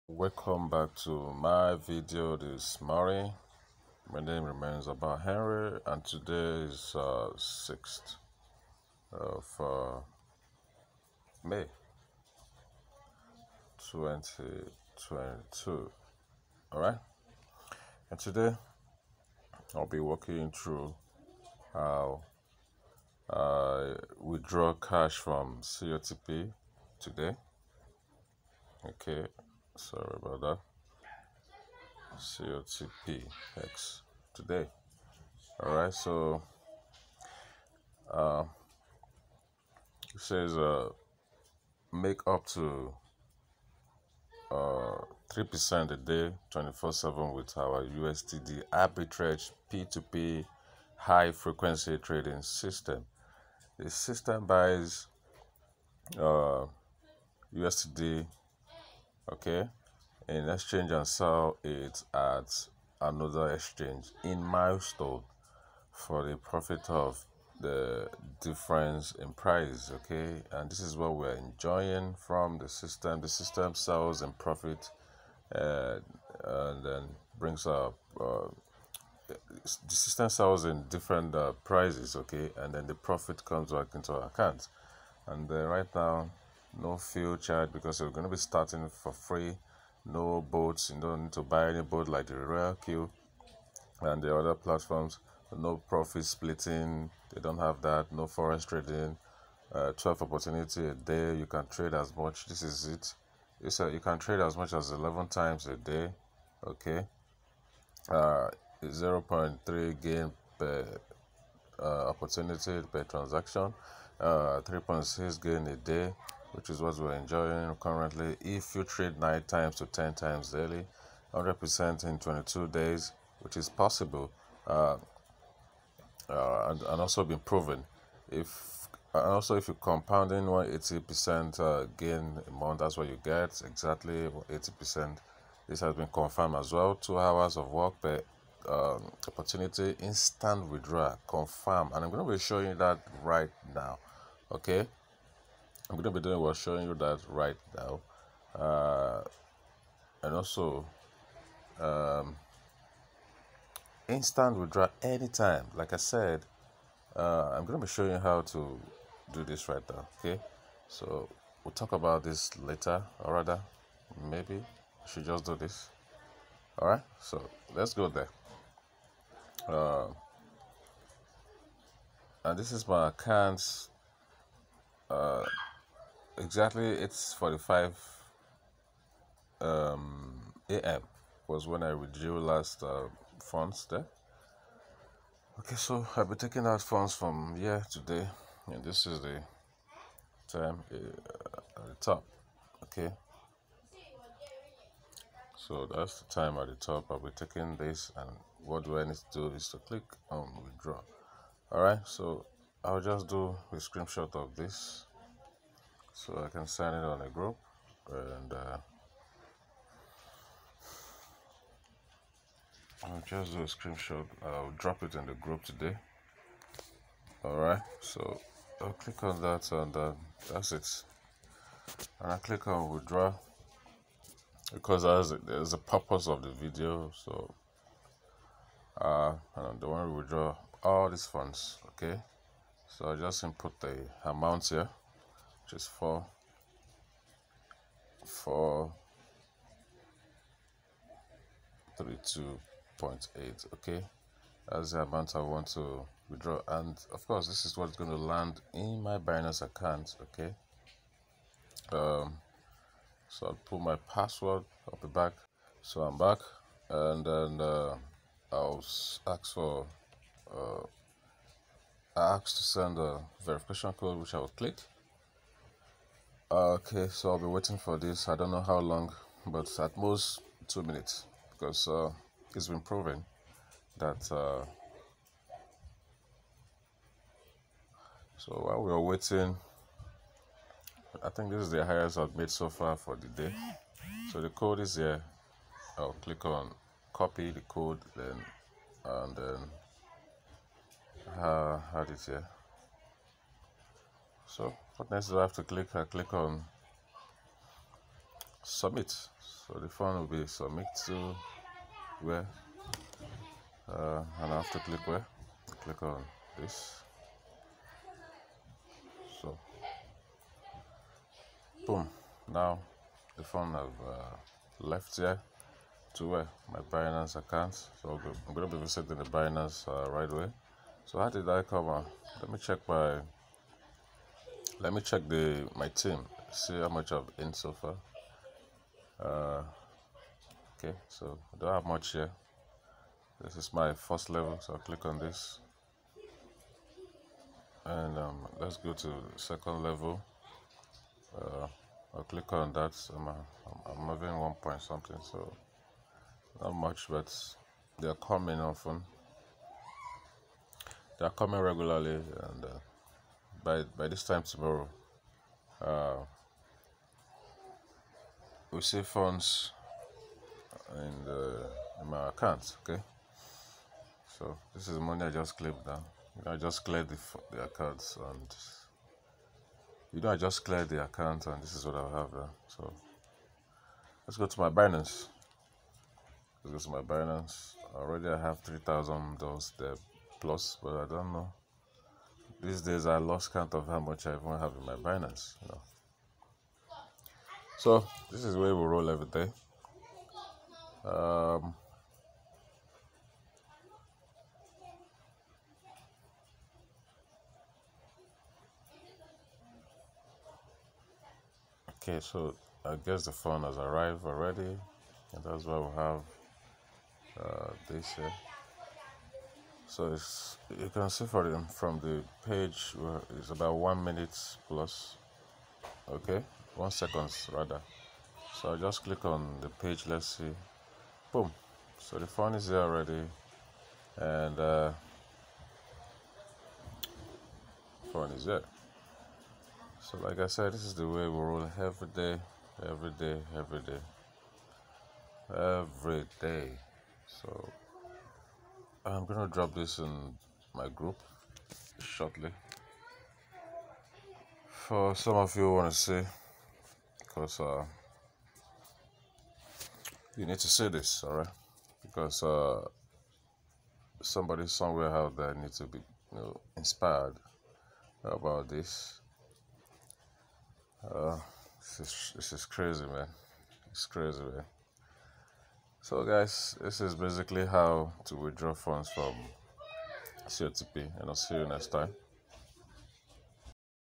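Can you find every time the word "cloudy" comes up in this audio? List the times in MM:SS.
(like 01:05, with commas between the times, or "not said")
not said.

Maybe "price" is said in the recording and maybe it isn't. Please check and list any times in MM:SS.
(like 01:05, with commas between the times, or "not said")
01:09, 01:21.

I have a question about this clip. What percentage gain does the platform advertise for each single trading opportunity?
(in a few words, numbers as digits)
0.3.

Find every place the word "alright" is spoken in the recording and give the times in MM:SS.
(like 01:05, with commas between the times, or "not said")
00:16, 03:37, 07:31.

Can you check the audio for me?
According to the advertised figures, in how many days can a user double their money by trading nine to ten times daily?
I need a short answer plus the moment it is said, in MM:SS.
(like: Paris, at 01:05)
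22 days, at 02:02.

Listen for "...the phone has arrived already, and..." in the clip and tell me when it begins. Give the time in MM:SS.
06:43.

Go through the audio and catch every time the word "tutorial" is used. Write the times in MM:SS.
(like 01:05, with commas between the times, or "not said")
not said.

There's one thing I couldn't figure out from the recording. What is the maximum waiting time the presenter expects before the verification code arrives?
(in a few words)
2 minutes.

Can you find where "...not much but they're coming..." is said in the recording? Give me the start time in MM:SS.
05:46.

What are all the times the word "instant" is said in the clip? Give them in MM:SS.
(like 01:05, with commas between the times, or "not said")
02:20, 02:34.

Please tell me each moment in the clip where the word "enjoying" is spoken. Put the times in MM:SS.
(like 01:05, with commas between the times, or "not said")
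01:11, 01:57.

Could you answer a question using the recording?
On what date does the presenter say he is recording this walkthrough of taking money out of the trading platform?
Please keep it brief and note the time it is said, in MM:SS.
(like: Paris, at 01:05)
6 May 2022, at 00:07.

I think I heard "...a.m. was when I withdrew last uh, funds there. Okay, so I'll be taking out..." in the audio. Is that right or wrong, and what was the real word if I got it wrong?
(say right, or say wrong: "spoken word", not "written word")
right.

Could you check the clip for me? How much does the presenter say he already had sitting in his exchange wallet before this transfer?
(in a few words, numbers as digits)
$3000.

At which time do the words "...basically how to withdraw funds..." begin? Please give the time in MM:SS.
07:47.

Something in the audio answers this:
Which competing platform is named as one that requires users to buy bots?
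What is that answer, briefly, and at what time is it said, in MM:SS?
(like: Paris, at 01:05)
Royal Q, at 01:32.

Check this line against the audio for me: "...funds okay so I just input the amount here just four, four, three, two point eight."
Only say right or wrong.
right.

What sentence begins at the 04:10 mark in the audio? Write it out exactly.
Okay, um, so I'll put my password.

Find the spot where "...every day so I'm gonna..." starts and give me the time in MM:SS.
07:15.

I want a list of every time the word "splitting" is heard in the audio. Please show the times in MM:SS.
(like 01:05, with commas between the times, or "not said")
01:36.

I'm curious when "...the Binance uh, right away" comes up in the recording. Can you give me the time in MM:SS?
05:19.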